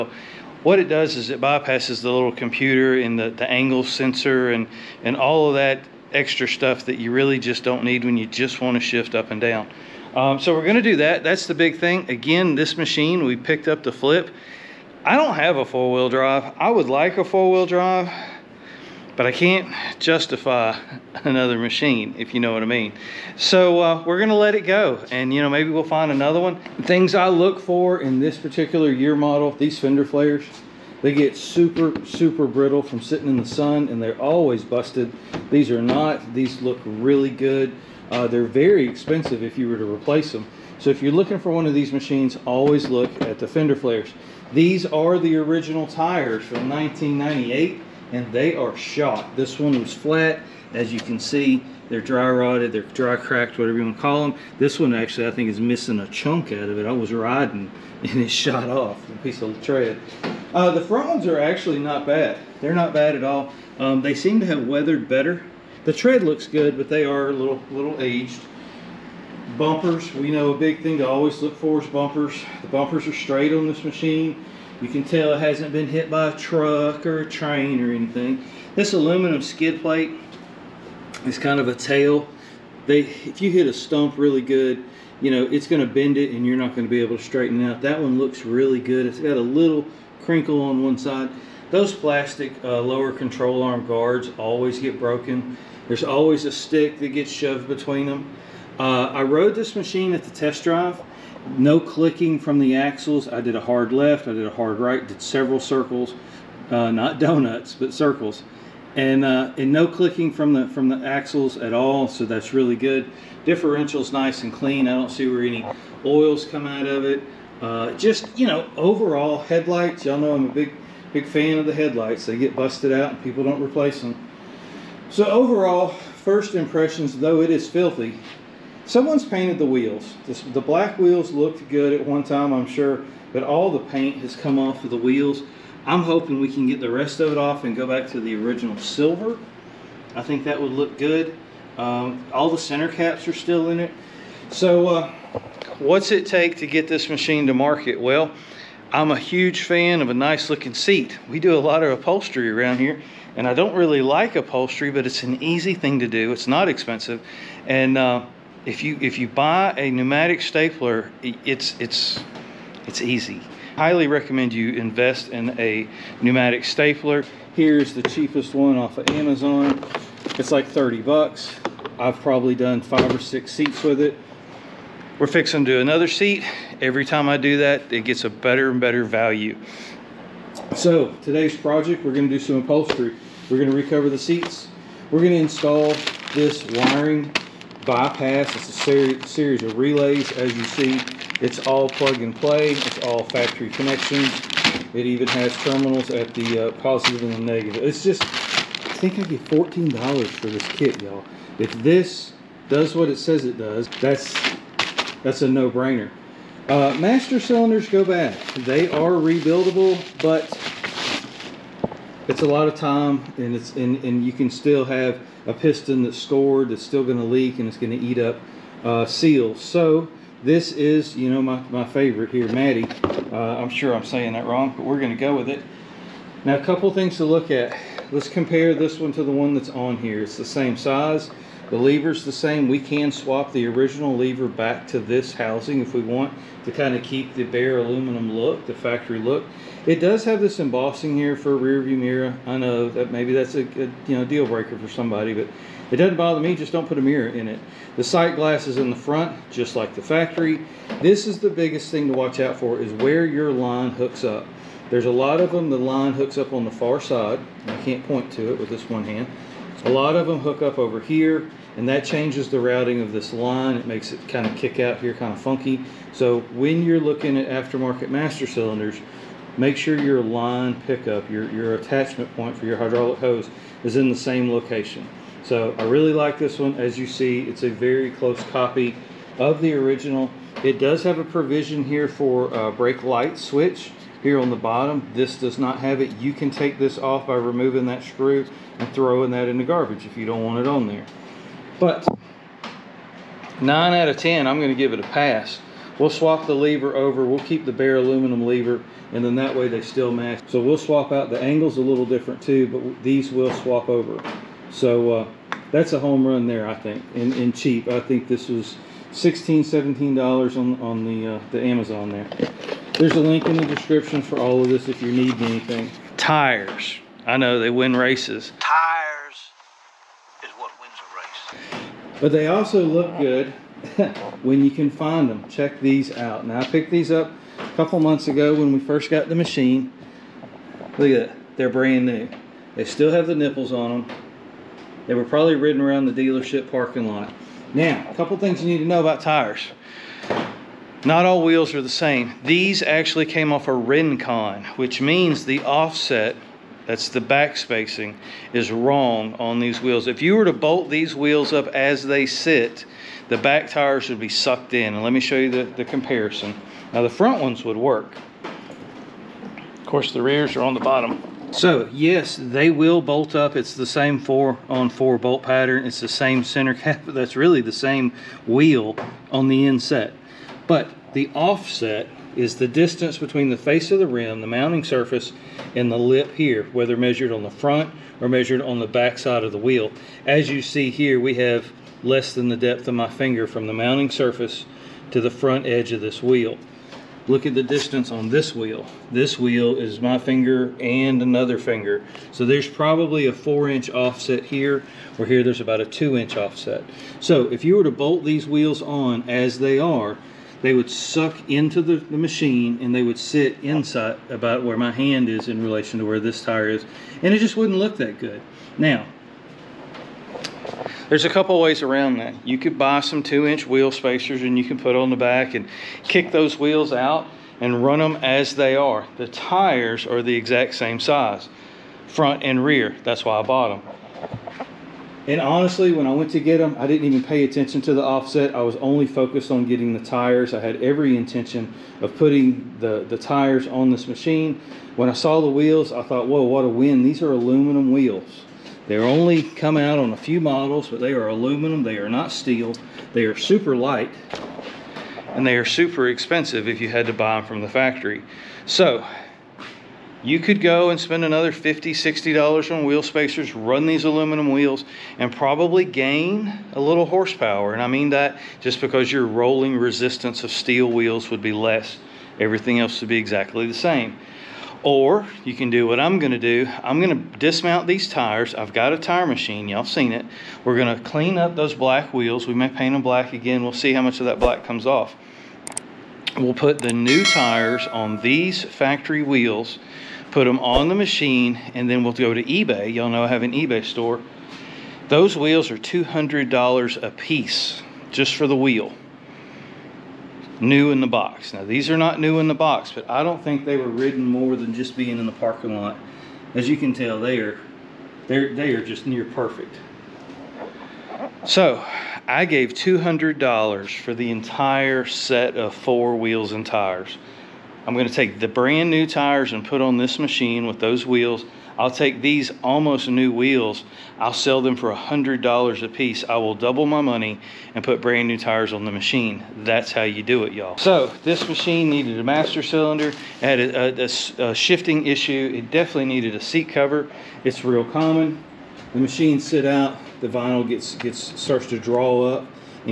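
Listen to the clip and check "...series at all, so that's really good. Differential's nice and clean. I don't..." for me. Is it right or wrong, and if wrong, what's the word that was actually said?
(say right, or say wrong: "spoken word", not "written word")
wrong: "axles", not "series".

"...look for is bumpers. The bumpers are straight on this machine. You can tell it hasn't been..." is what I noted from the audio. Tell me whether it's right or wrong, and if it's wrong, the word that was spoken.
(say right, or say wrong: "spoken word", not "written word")
right.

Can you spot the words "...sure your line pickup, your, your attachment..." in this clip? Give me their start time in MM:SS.
04:29.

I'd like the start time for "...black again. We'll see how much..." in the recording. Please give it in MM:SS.
07:53.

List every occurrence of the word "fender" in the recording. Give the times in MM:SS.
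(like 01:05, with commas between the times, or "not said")
00:29, 00:43.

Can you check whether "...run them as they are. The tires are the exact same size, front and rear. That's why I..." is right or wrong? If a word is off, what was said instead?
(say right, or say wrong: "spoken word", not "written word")
right.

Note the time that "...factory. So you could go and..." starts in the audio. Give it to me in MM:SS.
07:27.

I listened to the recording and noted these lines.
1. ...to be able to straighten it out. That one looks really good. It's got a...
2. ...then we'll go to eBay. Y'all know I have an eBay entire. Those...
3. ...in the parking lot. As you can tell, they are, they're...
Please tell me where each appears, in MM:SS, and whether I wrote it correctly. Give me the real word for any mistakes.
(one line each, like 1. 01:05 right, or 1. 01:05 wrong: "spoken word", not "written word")
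1. 01:26 right
2. 08:01 wrong: "store", not "entire"
3. 08:15 right.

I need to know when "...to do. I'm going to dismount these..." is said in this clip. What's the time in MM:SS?
07:46.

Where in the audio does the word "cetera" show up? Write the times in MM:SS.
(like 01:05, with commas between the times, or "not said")
not said.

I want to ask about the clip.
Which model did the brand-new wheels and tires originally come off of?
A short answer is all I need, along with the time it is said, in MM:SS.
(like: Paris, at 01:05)
Rincon, at 05:43.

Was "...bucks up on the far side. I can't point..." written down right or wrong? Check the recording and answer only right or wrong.
wrong.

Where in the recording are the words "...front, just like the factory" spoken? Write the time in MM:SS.
04:08.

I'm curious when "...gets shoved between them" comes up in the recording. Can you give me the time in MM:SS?
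01:37.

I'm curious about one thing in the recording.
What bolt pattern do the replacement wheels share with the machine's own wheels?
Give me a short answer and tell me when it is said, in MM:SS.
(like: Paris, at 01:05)
four on four, at 06:04.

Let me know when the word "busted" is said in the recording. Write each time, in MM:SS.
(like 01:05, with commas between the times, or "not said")
00:34, 02:02.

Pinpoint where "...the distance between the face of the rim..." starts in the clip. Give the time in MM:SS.
06:12.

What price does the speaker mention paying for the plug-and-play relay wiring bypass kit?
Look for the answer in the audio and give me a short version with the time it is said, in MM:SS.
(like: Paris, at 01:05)
$14, at 03:19.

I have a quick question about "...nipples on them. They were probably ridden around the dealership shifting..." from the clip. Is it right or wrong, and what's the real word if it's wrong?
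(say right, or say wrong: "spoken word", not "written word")
wrong: "parking", not "shifting".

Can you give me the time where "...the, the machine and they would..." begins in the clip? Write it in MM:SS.
06:41.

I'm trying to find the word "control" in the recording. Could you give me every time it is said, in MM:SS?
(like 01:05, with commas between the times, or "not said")
01:33.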